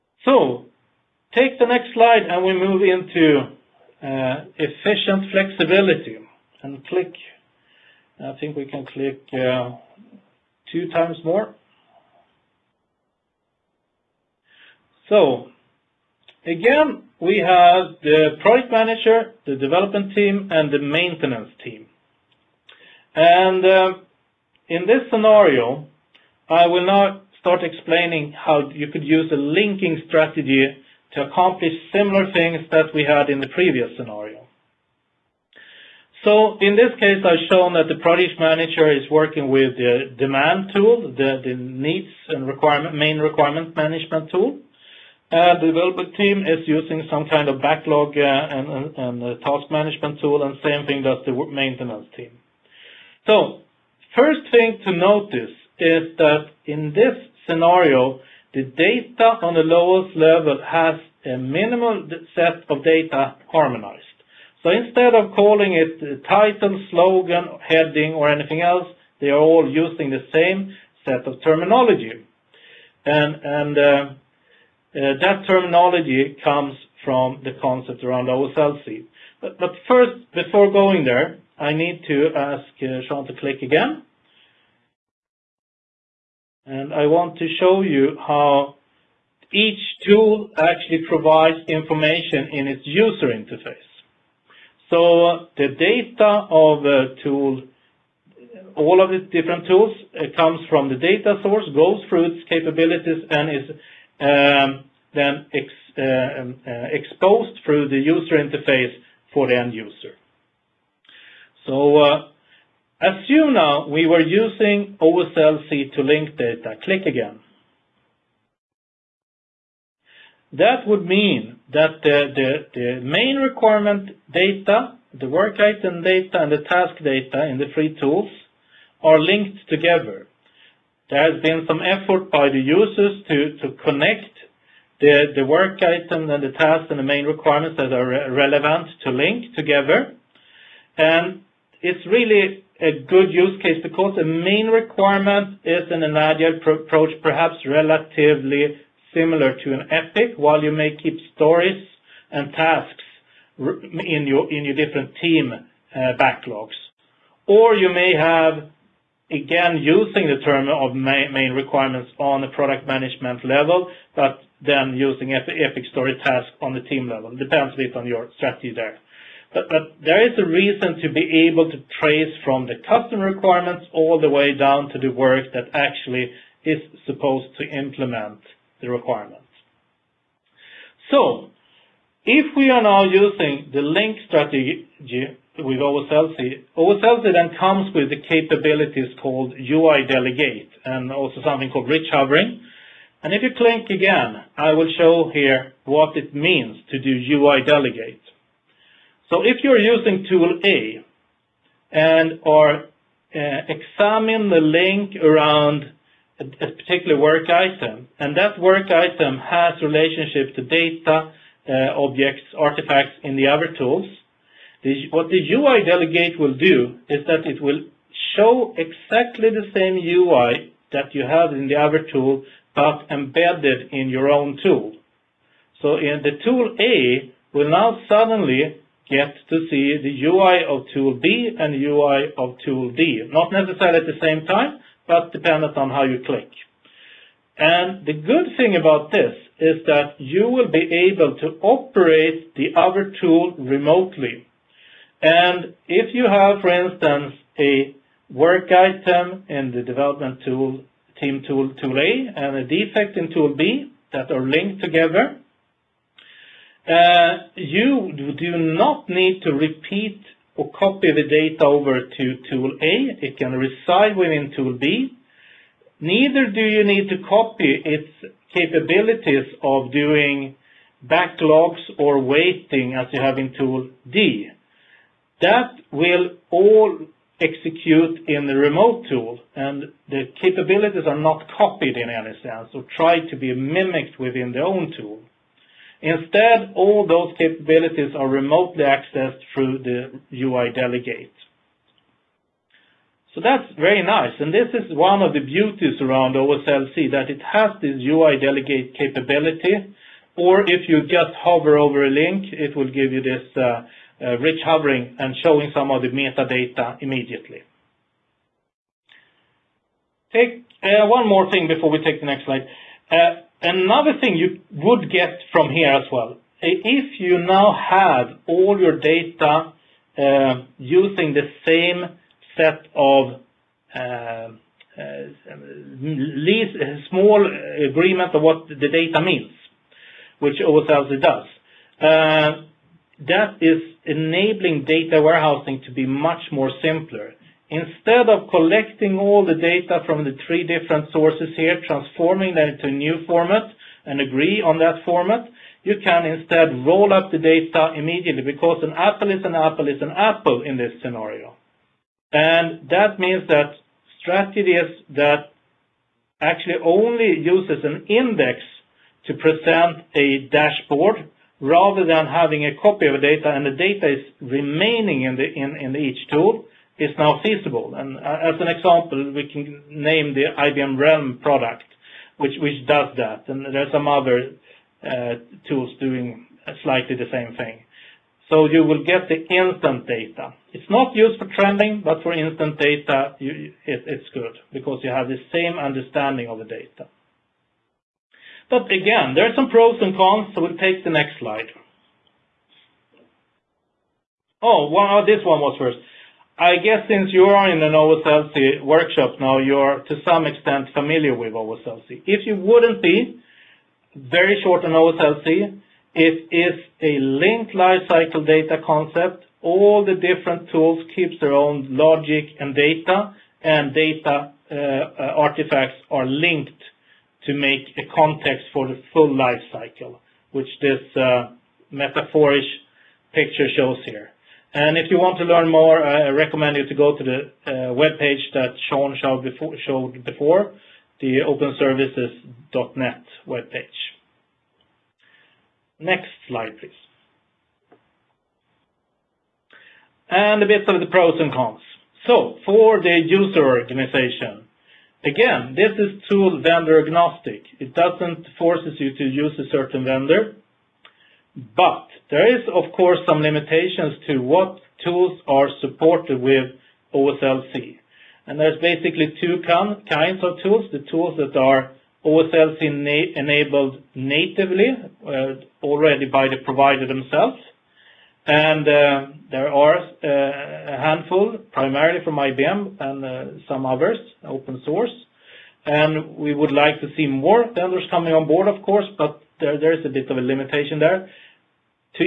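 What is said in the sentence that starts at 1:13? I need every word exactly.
And, and uh, uh, that terminology comes from the concept around OSLC.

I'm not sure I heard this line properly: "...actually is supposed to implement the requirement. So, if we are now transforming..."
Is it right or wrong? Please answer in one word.
wrong.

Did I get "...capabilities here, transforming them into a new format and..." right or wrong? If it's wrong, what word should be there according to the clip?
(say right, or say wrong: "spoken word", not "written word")
wrong: "sources", not "capabilities".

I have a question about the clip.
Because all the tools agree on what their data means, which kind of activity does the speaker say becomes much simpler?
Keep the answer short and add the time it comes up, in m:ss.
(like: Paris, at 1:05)
Data warehousing, at 5:34.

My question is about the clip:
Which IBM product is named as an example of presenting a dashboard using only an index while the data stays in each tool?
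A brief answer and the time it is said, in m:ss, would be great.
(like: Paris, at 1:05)
IBM RELM, at 6:10.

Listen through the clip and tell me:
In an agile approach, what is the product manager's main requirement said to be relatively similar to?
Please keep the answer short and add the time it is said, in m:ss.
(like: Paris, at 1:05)
an epic, at 2:27.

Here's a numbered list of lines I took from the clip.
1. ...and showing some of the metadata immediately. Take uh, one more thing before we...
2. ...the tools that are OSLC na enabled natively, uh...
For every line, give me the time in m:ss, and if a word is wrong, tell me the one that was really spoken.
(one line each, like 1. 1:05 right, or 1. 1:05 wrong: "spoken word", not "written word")
1. 5:05 right
2. 7:40 right.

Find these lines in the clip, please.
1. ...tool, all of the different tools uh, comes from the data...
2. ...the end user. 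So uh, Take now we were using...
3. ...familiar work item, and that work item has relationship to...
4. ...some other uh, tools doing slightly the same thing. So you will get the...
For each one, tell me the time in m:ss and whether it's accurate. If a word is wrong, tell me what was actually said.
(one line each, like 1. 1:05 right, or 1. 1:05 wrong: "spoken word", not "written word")
1. 1:37 right
2. 1:49 wrong: "Assume", not "Take"
3. 3:26 wrong: "particular", not "familiar"
4. 6:13 right.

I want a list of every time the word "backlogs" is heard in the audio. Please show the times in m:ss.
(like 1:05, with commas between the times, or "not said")
0:47, 2:36, 4:31.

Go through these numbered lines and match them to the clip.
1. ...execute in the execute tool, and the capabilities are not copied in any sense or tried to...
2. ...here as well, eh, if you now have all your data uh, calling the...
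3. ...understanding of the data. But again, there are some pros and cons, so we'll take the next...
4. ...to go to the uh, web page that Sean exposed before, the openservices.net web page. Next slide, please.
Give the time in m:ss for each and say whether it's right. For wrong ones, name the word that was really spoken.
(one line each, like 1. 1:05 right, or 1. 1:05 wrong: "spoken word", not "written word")
1. 4:37 wrong: "remote", not "execute"
2. 5:15 wrong: "using", not "calling"
3. 6:25 right
4. 7:06 wrong: "showed", not "exposed".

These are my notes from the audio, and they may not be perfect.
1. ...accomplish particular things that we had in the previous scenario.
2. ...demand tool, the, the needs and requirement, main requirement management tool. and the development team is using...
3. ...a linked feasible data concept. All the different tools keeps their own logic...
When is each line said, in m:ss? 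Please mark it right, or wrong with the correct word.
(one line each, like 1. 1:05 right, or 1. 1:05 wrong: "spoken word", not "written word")
1. 0:31 wrong: "similar", not "particular"
2. 0:40 right
3. 6:47 wrong: "lifecycle", not "feasible".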